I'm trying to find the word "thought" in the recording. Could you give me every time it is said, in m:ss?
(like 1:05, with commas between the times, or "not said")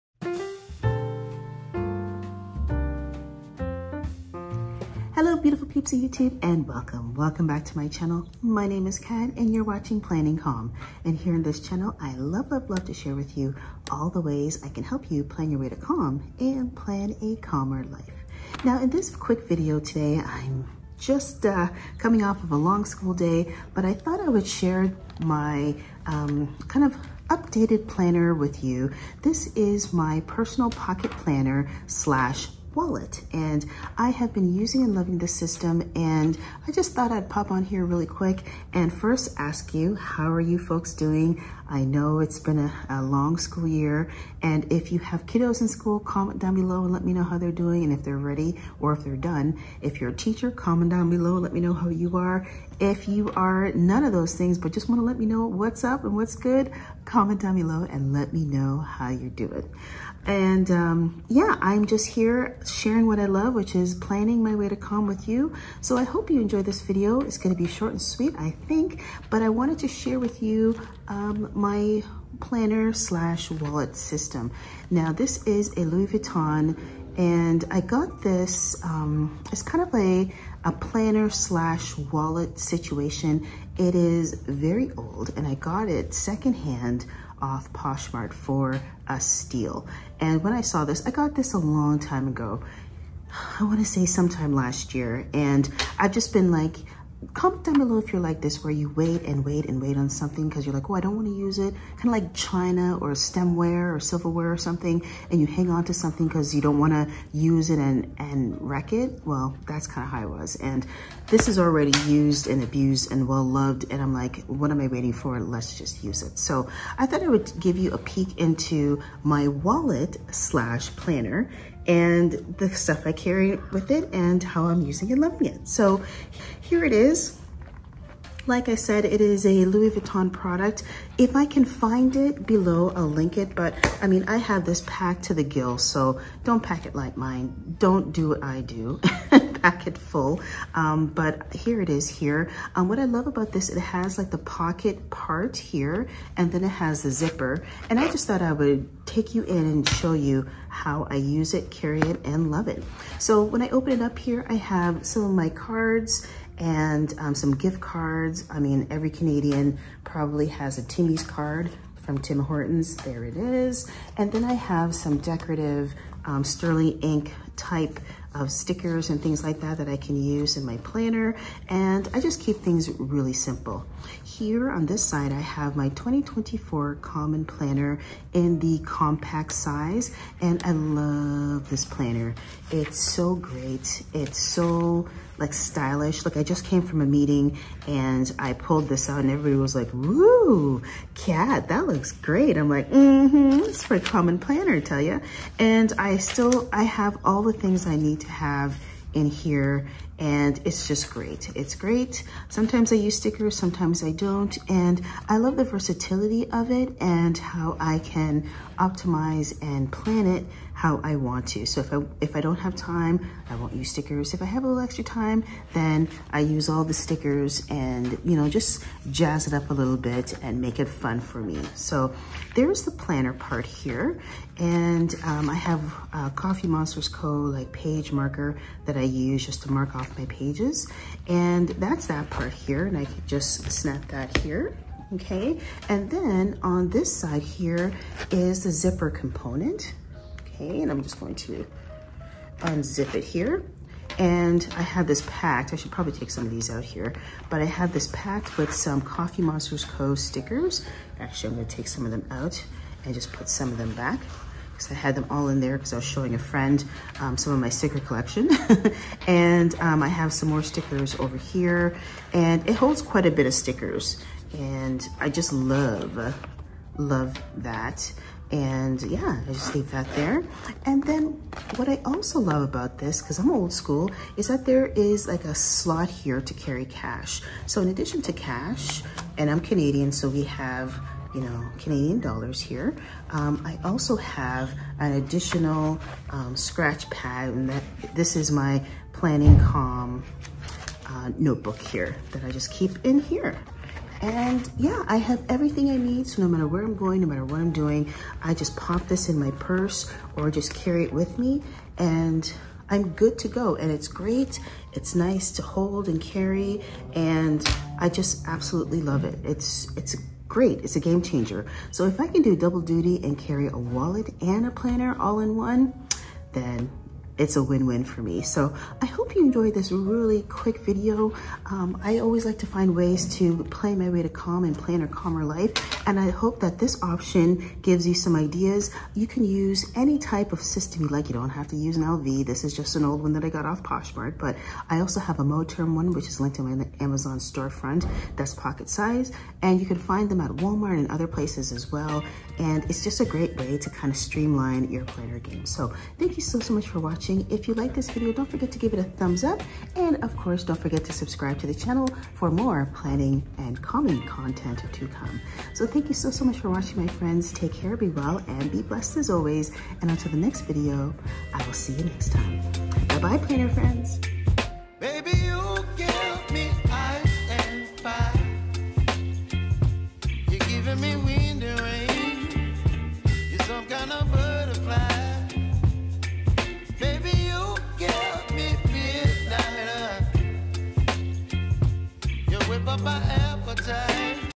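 0:23, 0:36, 1:57, 2:28.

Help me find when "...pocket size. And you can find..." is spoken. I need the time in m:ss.
5:38.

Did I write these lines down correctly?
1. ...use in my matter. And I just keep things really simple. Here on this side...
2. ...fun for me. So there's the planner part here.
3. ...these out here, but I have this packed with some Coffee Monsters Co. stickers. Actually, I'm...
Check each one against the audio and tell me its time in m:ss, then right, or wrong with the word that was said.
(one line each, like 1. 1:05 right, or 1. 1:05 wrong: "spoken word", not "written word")
1. 2:50 wrong: "planner", not "matter"
2. 3:40 right
3. 4:06 right.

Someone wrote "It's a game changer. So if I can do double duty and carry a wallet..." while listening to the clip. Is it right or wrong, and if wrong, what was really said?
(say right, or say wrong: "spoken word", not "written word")
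right.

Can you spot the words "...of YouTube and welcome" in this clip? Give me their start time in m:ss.
0:05.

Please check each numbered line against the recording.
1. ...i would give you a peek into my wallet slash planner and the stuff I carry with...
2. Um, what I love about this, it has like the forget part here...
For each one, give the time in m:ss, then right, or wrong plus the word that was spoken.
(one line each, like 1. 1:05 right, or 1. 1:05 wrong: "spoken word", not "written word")
1. 1:57 right
2. 2:22 wrong: "pocket", not "forget".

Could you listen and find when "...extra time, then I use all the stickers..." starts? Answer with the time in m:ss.
3:34.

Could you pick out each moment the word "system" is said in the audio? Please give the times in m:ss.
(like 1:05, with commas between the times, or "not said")
0:35, 1:13, 5:30.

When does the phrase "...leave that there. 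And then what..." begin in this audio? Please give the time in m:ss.
4:29.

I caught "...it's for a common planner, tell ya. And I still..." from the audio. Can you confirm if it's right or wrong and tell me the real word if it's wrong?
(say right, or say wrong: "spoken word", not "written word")
right.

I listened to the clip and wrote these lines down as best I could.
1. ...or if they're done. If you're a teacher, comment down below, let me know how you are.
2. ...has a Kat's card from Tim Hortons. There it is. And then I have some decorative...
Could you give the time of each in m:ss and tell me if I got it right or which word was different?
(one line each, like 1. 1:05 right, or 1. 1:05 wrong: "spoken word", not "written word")
1. 0:48 right
2. 2:40 wrong: "Timmy", not "Kat".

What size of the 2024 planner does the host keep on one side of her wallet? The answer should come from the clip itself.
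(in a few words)
compact.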